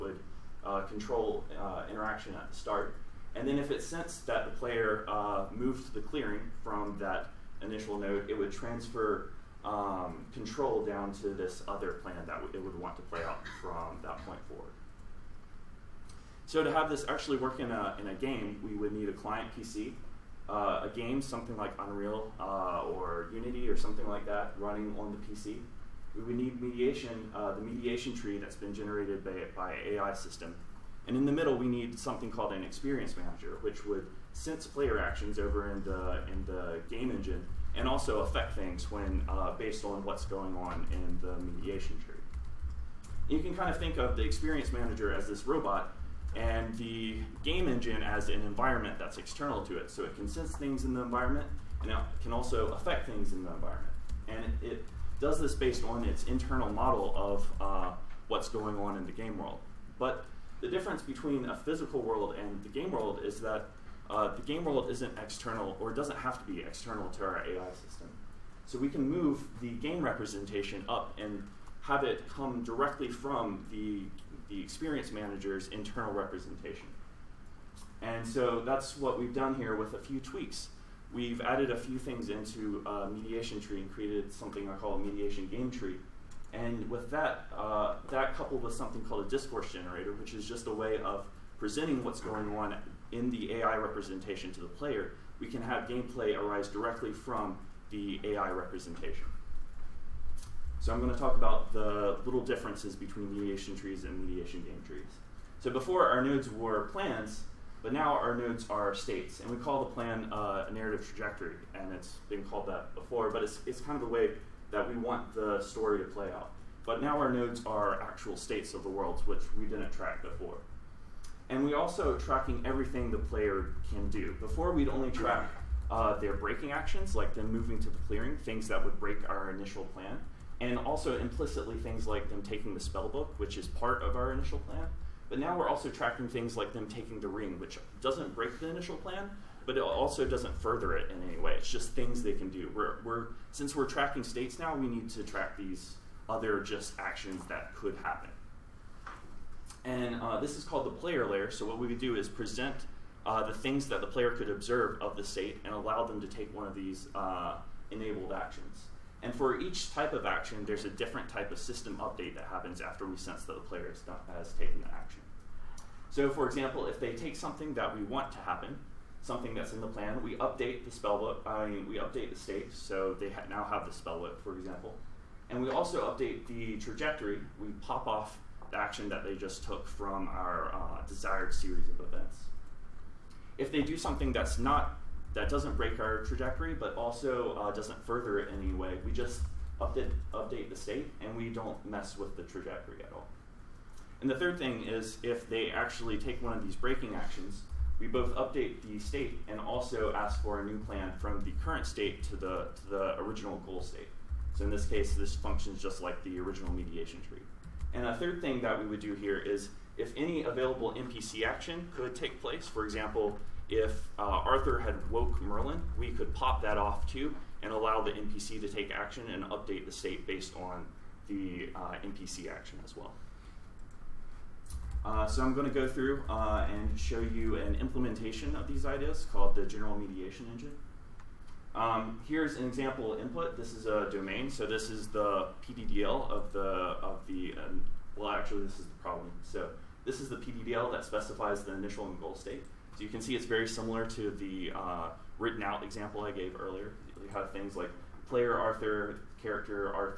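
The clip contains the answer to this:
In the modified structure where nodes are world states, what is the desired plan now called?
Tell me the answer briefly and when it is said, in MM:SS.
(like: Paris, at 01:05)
narrative trajectory, at 01:50.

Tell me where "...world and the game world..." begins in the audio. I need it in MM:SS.
01:02.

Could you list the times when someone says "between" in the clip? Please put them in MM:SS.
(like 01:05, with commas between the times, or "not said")
01:01, 01:42.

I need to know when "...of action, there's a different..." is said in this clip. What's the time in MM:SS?
02:40.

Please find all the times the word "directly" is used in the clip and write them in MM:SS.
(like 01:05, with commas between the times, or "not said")
01:12, 01:36.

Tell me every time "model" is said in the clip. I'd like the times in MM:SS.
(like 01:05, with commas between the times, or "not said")
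00:56.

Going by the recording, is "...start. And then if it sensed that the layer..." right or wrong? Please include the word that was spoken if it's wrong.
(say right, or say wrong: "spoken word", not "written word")
wrong: "player", not "layer".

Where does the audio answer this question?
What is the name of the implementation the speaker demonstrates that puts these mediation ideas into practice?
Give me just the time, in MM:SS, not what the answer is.
03:49.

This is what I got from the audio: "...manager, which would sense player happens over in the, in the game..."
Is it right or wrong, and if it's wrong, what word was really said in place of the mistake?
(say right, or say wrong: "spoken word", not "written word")
wrong: "actions", not "happens".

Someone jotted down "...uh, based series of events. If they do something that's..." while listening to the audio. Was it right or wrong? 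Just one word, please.
wrong.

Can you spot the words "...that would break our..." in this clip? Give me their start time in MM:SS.
02:08.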